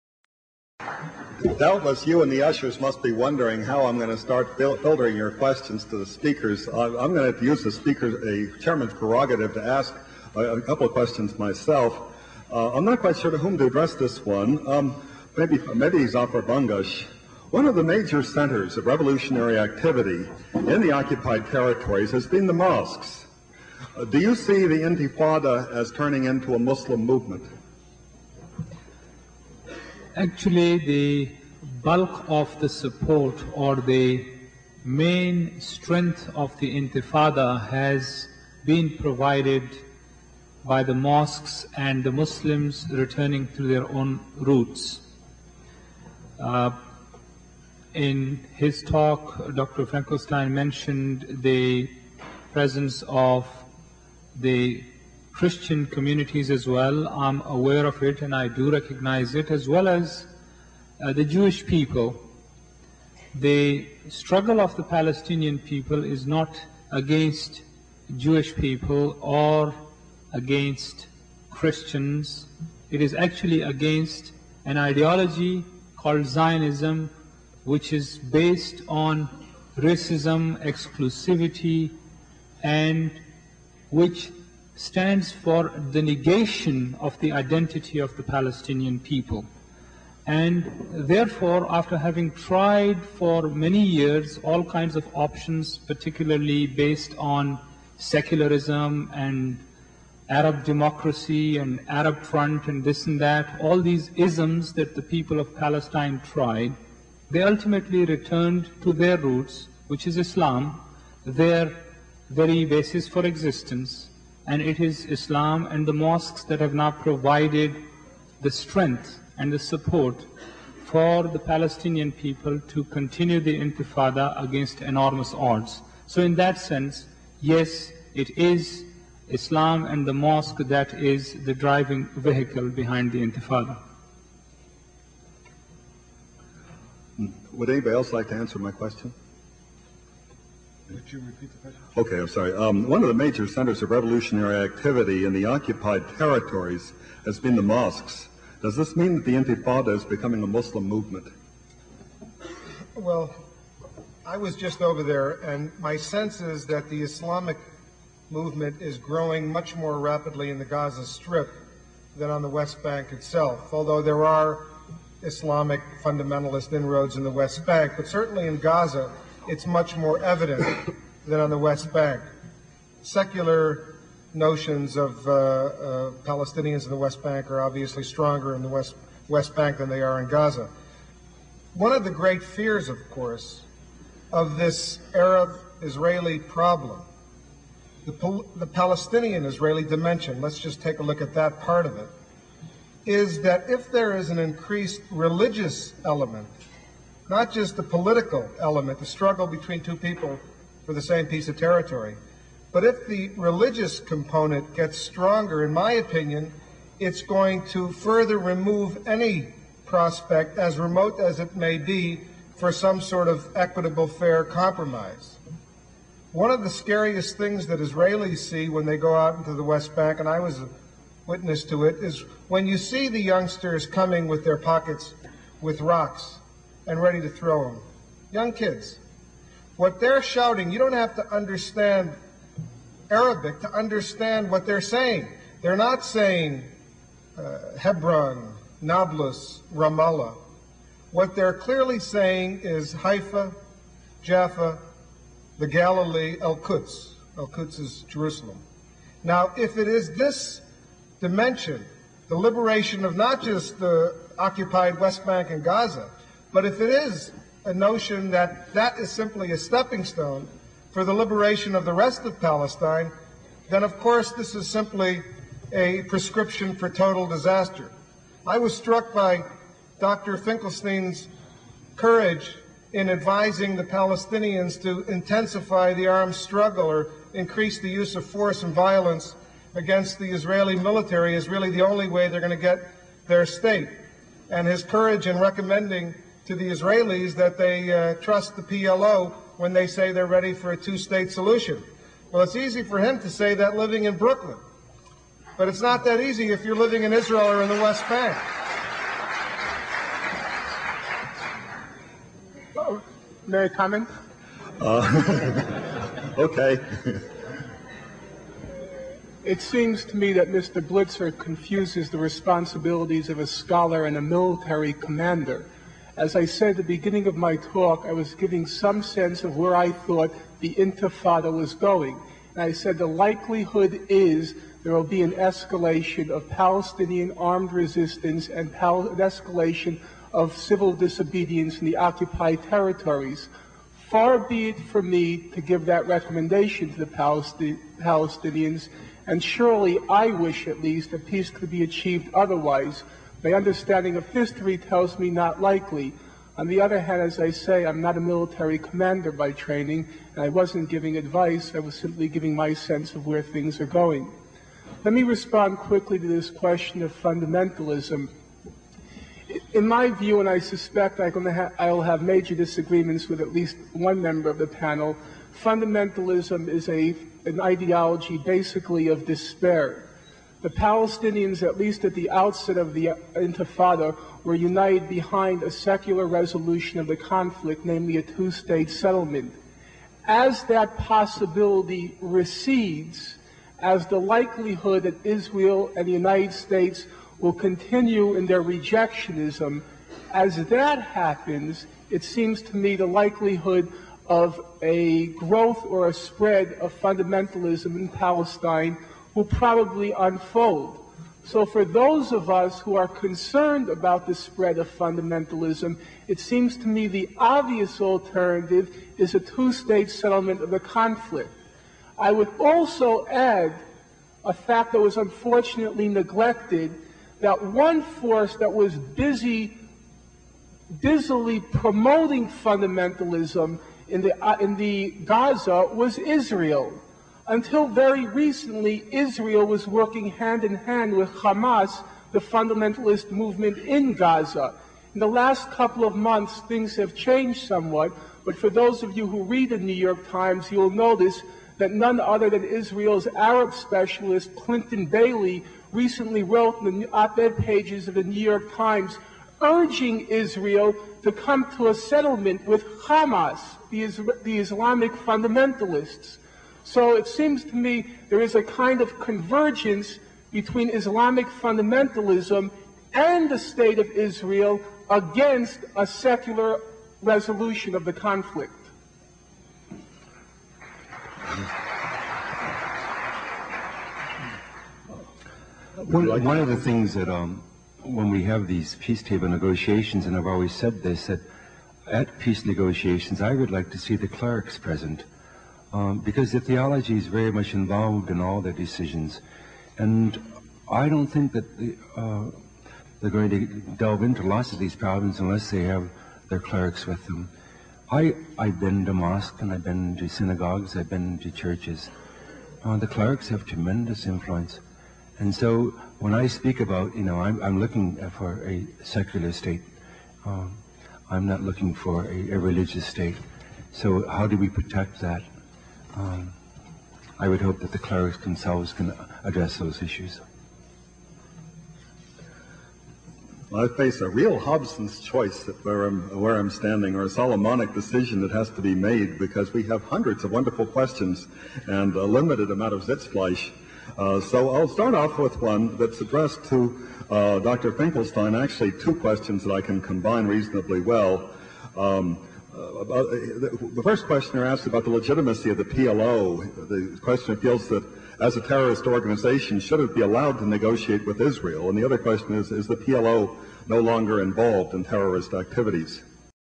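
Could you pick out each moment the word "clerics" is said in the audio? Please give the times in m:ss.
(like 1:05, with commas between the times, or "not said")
8:04, 8:16, 8:23, 8:37.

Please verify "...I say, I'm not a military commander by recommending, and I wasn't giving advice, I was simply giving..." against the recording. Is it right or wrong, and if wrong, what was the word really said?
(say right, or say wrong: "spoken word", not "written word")
wrong: "training", not "recommending".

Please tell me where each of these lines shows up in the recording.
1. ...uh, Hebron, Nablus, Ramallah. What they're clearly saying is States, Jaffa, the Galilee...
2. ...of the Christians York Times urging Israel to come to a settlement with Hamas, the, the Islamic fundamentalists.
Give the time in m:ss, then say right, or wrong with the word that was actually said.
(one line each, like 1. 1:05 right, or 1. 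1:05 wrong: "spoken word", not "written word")
1. 3:57 wrong: "Haifa", not "States"
2. 7:28 wrong: "New", not "Christians".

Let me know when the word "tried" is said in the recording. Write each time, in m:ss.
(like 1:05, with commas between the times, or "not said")
1:32, 1:46.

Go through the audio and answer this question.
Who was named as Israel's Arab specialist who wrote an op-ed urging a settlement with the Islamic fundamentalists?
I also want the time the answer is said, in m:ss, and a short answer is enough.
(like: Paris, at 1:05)
Clinton Bailey, at 7:24.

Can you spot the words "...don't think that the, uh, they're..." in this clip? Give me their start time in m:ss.
8:11.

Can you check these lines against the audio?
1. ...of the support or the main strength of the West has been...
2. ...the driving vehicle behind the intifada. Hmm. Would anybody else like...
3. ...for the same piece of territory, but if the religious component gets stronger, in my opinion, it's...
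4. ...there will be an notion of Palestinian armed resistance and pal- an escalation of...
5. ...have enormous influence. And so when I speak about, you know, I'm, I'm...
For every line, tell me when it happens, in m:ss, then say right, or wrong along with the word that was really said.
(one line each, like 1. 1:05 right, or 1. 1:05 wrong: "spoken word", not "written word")
1. 0:32 wrong: "Intifada", not "West"
2. 2:11 right
3. 3:20 right
4. 5:24 wrong: "escalation", not "notion"
5. 8:23 wrong: "tremendous", not "enormous".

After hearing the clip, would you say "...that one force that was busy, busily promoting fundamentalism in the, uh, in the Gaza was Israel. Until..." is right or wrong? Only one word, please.
right.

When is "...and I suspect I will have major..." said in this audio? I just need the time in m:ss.
6:00.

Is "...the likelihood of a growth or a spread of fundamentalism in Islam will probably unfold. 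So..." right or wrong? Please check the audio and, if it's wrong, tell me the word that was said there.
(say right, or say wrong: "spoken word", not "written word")
wrong: "Palestine", not "Islam".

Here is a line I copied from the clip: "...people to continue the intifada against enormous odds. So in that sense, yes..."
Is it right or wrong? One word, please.
right.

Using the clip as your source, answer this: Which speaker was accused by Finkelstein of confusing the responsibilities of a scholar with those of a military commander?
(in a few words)
Mr. Blitzer.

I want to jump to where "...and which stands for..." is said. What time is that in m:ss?
1:22.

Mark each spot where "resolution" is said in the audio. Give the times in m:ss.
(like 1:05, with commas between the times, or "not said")
6:16, 7:47.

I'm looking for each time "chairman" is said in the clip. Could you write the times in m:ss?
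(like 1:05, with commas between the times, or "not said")
0:08.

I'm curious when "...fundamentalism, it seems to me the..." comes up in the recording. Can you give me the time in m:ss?
6:44.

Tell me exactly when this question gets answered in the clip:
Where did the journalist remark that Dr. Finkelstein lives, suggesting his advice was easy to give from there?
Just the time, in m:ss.
4:54.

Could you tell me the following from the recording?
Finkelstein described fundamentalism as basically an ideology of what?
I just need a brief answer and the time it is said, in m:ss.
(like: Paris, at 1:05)
despair, at 6:09.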